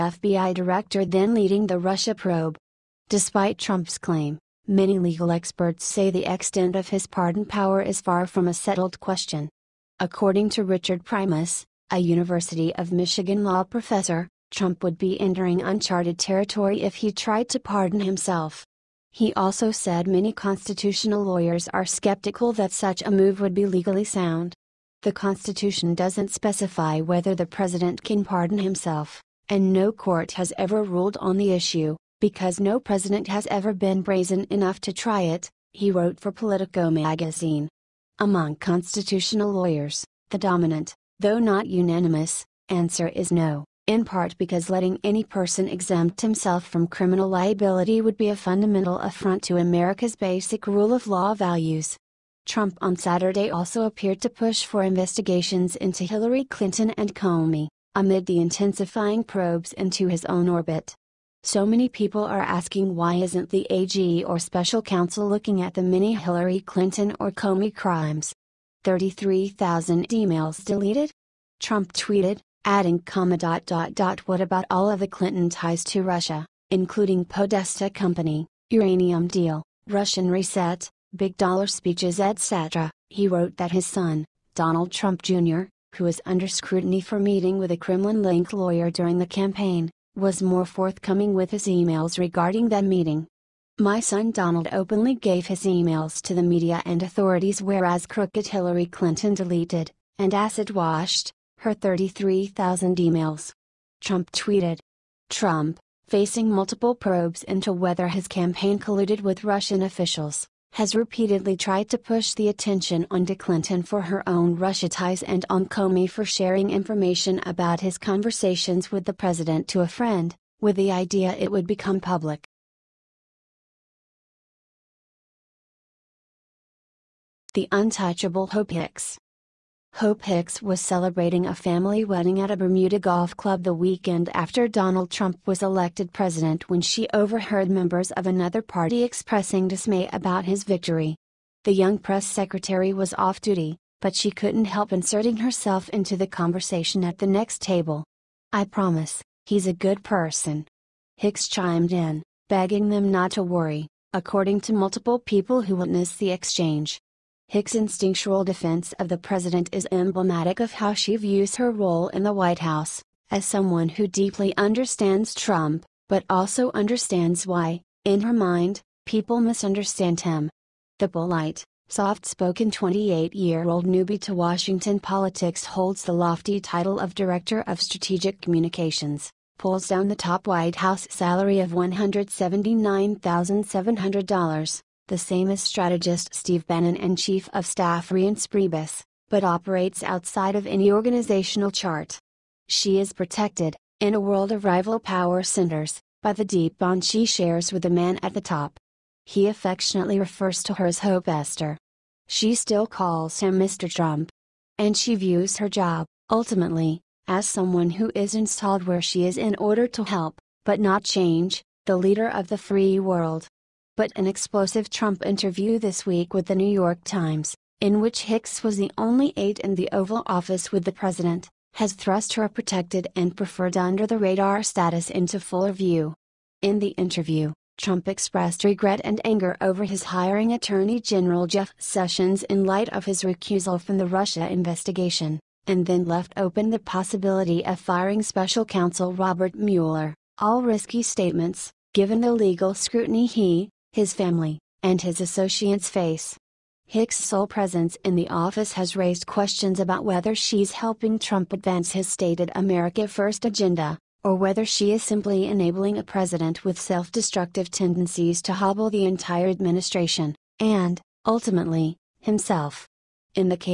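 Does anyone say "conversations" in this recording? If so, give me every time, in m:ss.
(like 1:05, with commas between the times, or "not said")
1:57, 2:26.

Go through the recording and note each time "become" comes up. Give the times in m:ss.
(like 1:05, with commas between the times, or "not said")
2:01.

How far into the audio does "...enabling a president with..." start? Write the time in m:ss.
4:15.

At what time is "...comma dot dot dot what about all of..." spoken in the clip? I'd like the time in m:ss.
1:12.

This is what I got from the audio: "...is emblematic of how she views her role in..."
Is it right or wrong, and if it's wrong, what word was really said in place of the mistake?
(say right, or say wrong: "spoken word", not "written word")
right.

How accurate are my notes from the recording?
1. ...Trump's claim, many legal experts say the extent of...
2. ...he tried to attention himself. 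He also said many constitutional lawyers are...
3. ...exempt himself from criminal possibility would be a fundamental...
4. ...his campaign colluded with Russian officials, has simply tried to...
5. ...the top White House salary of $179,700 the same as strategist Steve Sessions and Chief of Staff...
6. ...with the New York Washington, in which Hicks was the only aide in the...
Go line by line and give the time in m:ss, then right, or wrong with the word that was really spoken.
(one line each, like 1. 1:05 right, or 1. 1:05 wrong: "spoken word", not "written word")
1. 0:03 right
2. 0:16 wrong: "pardon", not "attention"
3. 0:45 wrong: "liability", not "possibility"
4. 1:48 wrong: "repeatedly", not "simply"
5. 3:00 wrong: "Bannon", not "Sessions"
6. 3:36 wrong: "Times", not "Washington".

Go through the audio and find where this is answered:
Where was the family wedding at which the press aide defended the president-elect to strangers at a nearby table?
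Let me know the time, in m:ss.
2:12.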